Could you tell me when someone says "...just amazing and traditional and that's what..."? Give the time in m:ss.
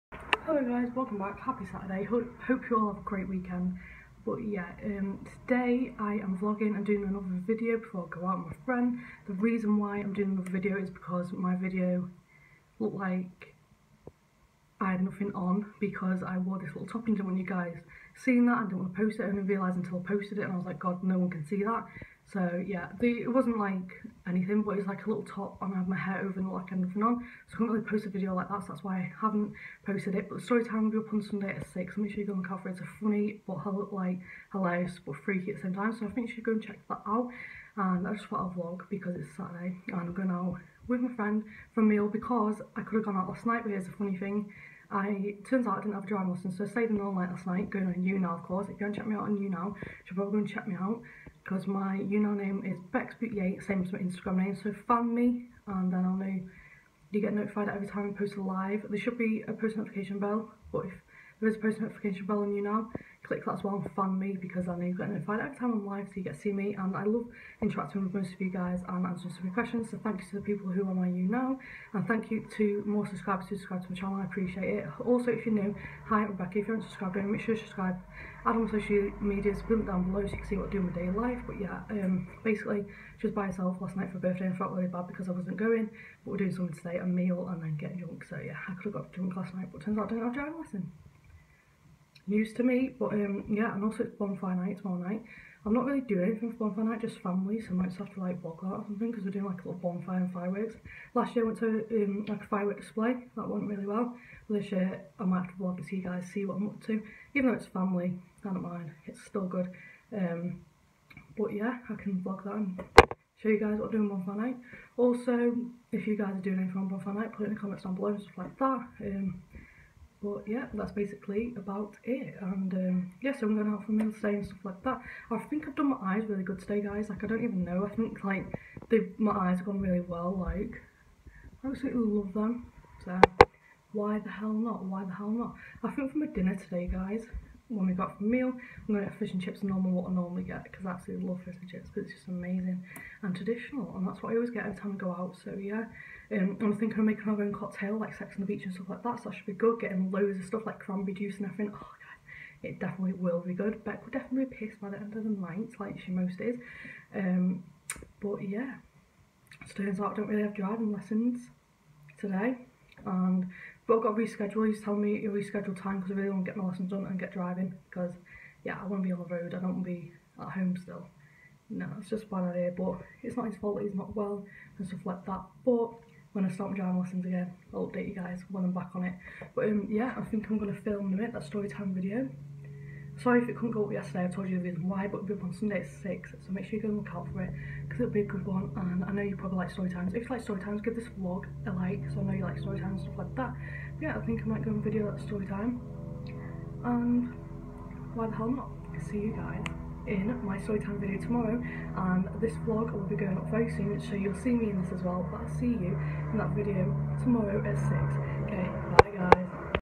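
2:22.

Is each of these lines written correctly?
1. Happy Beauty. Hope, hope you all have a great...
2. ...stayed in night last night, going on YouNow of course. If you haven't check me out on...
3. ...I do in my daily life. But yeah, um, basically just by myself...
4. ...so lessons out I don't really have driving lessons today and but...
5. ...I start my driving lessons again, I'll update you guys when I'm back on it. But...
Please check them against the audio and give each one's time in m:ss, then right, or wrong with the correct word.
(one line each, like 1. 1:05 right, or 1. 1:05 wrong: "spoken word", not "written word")
1. 0:01 wrong: "Saturday", not "Beauty"
2. 0:46 right
3. 1:20 right
4. 2:39 wrong: "turns", not "lessons"
5. 2:56 right.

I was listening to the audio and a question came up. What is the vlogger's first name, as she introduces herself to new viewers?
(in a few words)
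Rebecca.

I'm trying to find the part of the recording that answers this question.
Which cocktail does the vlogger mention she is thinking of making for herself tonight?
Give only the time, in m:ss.
2:28.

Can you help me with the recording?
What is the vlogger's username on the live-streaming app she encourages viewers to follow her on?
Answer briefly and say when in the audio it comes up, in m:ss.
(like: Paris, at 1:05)
Becks Beauty, at 0:52.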